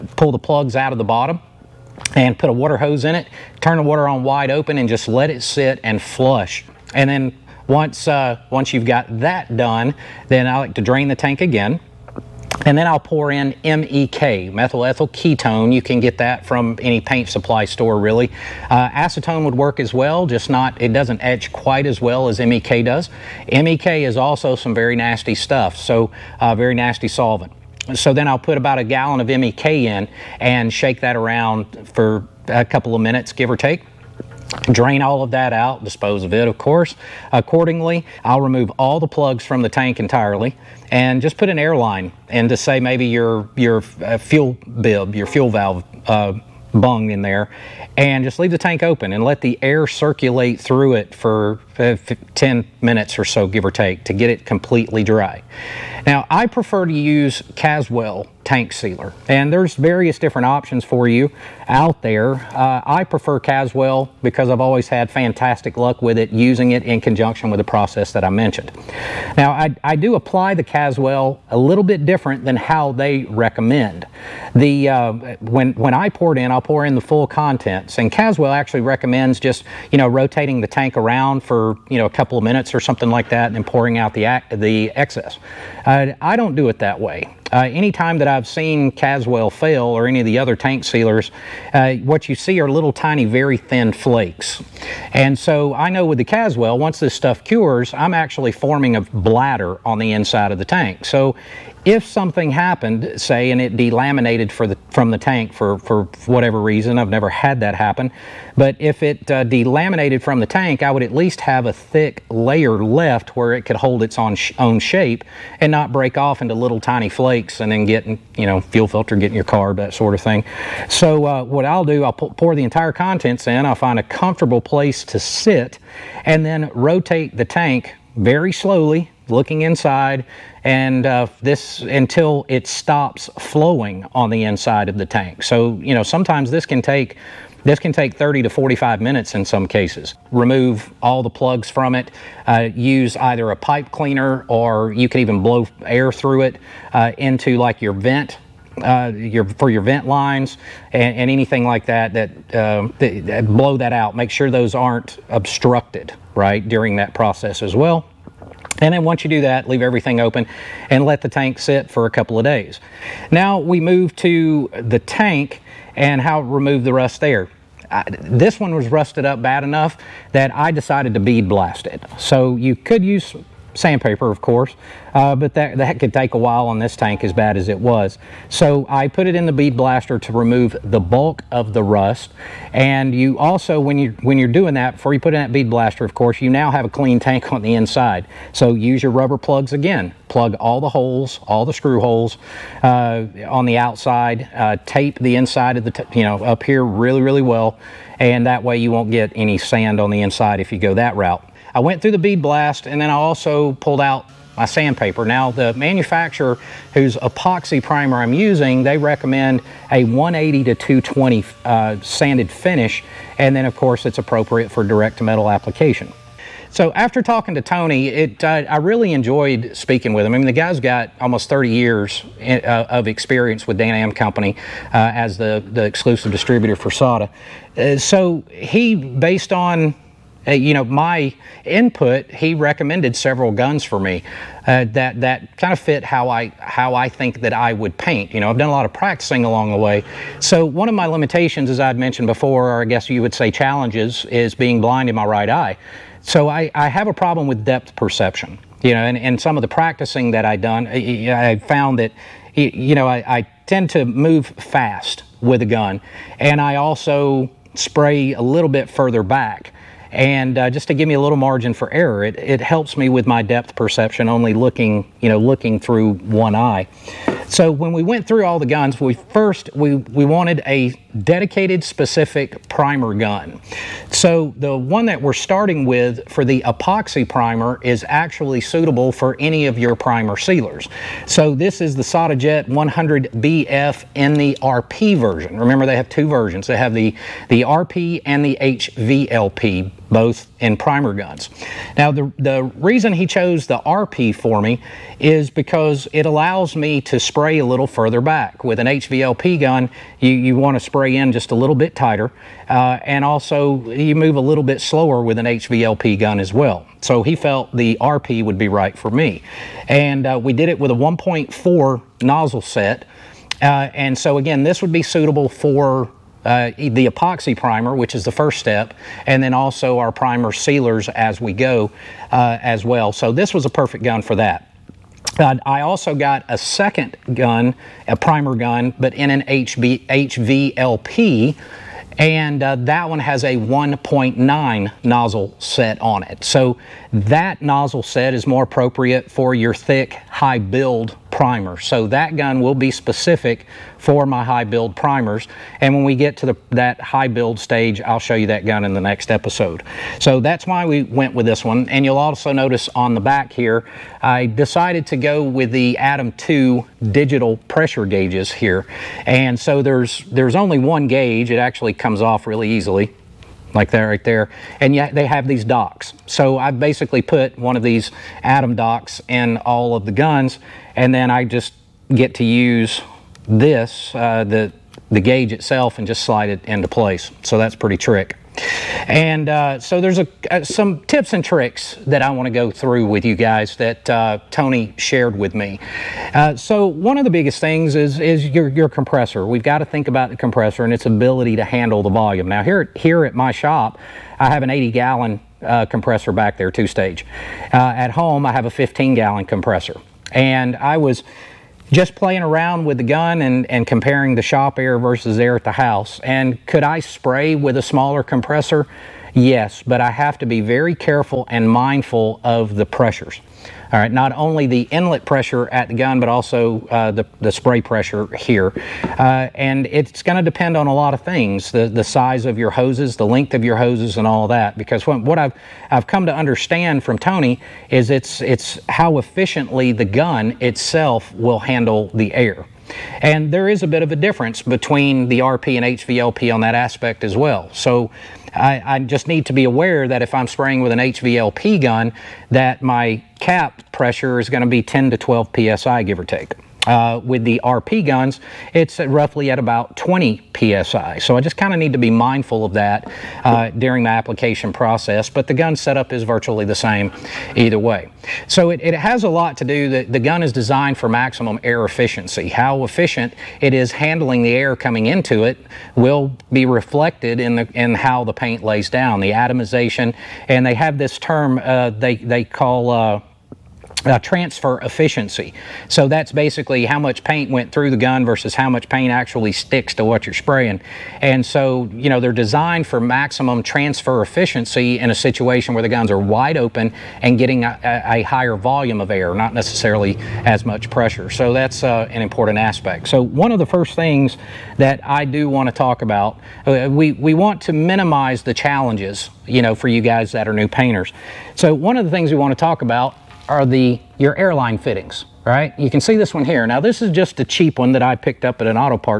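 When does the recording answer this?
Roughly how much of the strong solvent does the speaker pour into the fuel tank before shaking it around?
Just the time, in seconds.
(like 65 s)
28 s.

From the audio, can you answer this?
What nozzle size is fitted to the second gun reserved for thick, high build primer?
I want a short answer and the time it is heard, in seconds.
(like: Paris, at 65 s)
1.9, at 333 s.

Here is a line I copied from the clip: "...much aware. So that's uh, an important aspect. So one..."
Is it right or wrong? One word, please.
wrong.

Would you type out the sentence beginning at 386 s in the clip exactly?
Uh, so one of the biggest things is, is your, your compressor.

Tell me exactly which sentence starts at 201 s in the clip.
I went through the bead blast and then I also pulled out my sandpaper.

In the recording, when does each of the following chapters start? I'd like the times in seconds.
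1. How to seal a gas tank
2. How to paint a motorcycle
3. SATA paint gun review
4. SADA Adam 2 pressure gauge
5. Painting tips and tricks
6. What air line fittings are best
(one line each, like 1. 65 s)
1. 55 s
2. 162 s
3. 215 s
4. 351 s
5. 377 s
6. 493 s.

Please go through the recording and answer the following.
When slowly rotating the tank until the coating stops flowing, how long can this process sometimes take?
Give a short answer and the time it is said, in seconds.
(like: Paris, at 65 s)
30 to 45 minutes, at 138 s.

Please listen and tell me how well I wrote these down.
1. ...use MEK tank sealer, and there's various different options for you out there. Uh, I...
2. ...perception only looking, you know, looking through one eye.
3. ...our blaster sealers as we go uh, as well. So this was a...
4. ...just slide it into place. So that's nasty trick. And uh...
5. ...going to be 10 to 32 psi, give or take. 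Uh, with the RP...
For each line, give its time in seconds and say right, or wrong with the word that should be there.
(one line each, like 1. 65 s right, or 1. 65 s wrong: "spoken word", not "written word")
1. 56 s wrong: "Caswell", not "MEK"
2. 263 s right
3. 319 s wrong: "primer", not "blaster"
4. 376 s wrong: "pretty", not "nasty"
5. 444 s wrong: "12", not "32".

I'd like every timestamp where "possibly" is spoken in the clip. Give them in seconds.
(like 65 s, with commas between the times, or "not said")
not said.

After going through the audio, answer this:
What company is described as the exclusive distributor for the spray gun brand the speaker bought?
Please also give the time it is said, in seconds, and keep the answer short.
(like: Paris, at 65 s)
DanAm Company, at 223 s.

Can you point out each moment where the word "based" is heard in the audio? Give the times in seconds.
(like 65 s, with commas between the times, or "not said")
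228 s.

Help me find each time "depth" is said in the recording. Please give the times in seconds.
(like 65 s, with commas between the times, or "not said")
247 s, 263 s.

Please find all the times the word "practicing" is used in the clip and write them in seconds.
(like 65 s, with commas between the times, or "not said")
238 s, 249 s.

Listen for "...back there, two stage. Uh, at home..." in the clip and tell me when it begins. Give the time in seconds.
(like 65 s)
396 s.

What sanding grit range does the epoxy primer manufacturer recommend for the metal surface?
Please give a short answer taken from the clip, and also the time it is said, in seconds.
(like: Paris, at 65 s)
180 to 220, at 210 s.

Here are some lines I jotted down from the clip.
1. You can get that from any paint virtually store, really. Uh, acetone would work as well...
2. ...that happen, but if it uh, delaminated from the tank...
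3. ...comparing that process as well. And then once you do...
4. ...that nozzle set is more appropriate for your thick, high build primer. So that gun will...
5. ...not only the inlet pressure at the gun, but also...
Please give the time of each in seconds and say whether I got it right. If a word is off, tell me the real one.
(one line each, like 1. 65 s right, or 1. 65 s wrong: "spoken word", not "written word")
1. 15 s wrong: "supply", not "virtually"
2. 107 s right
3. 156 s wrong: "during", not "comparing"
4. 337 s right
5. 414 s right.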